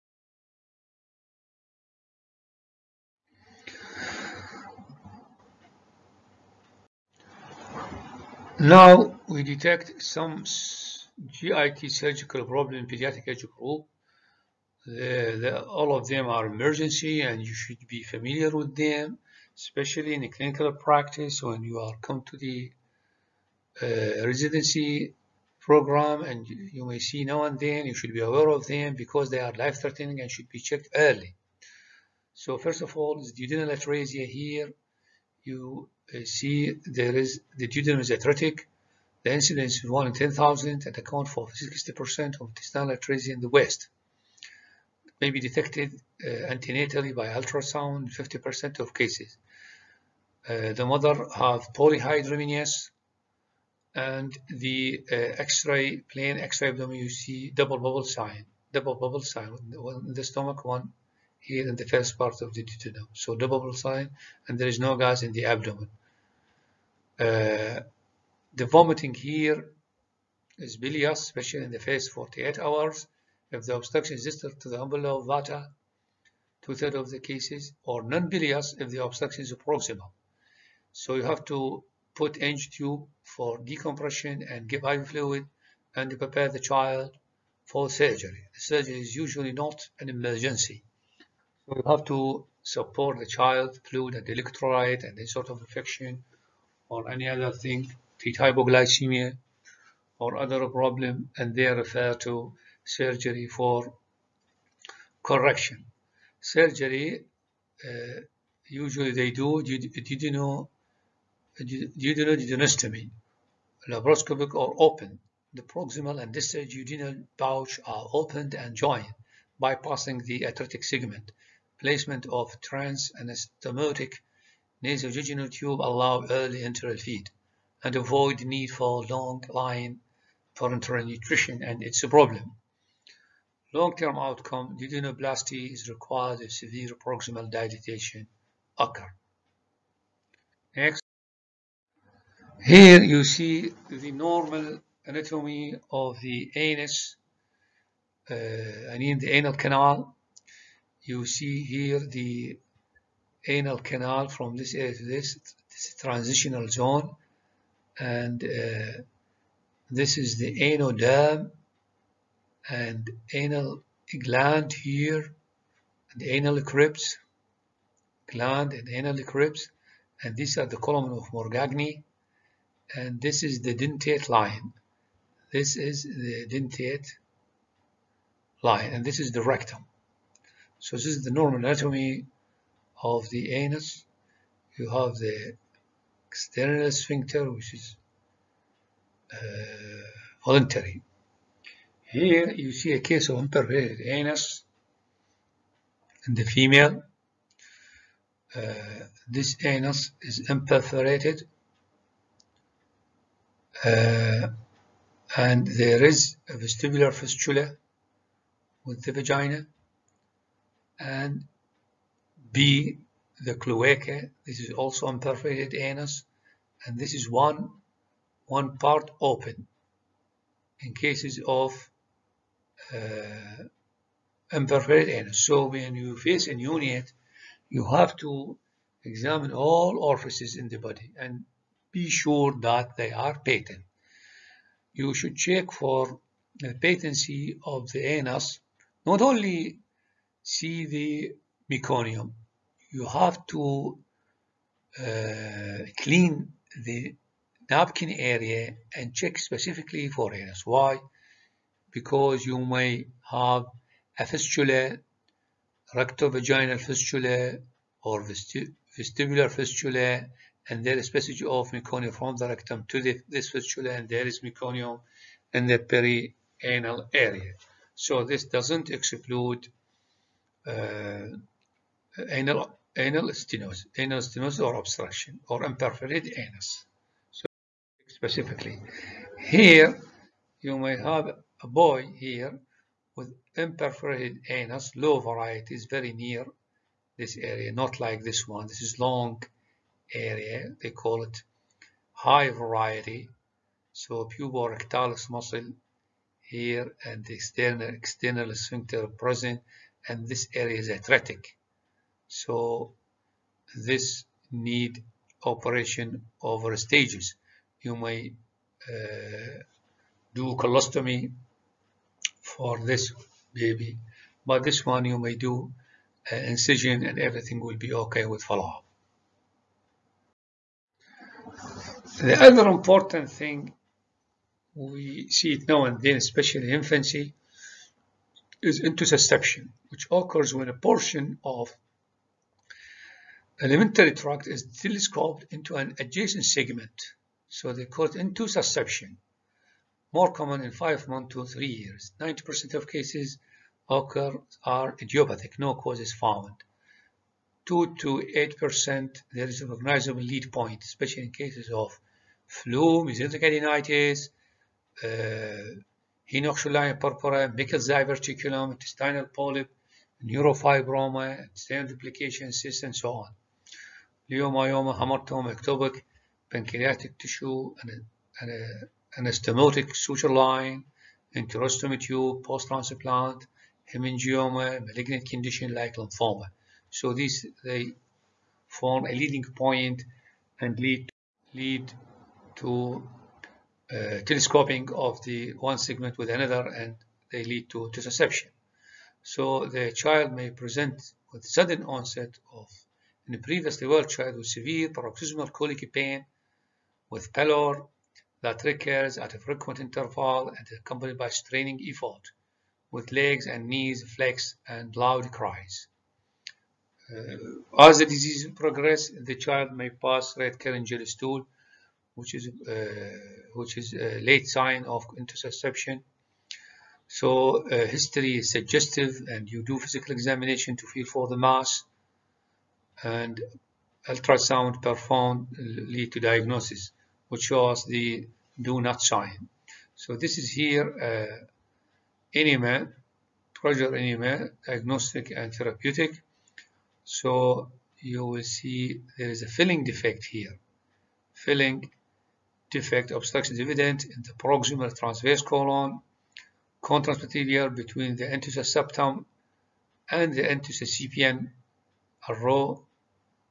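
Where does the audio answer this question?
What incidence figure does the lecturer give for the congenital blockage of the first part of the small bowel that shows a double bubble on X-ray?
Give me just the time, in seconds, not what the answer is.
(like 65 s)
39 s.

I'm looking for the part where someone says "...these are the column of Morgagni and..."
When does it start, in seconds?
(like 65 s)
170 s.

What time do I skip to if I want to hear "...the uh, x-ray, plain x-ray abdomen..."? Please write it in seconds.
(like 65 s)
54 s.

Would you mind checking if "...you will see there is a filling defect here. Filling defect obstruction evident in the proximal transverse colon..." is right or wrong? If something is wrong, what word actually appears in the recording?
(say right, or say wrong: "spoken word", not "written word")
right.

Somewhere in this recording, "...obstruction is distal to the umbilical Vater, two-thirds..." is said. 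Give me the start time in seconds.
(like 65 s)
73 s.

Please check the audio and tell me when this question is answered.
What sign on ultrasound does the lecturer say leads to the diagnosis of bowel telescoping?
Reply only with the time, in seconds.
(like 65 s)
428 s.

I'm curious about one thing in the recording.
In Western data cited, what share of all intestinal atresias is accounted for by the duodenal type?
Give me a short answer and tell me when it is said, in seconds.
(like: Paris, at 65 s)
60%, at 41 s.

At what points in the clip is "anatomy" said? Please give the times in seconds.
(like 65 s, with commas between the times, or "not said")
145 s, 181 s.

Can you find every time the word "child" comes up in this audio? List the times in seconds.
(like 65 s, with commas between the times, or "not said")
86 s, 93 s, 389 s, 394 s, 409 s.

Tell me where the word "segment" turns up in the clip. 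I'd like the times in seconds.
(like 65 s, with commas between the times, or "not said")
120 s, 336 s, 385 s.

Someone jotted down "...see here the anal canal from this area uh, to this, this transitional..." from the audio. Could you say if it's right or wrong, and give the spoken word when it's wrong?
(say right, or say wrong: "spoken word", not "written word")
right.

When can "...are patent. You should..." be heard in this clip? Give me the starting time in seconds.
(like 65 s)
233 s.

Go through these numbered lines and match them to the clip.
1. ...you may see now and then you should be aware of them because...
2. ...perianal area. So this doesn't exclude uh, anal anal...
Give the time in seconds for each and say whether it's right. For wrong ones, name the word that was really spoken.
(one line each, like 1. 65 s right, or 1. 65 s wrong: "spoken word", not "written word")
1. 26 s right
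2. 265 s right.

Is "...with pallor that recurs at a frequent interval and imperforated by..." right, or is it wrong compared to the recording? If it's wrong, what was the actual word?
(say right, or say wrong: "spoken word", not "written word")
wrong: "accompanied", not "imperforated".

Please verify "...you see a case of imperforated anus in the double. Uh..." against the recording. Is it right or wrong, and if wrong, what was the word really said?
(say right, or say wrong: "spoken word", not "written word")
wrong: "female", not "double".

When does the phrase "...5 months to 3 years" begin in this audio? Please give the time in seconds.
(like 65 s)
340 s.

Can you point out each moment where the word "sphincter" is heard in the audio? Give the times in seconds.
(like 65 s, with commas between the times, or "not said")
186 s, 298 s.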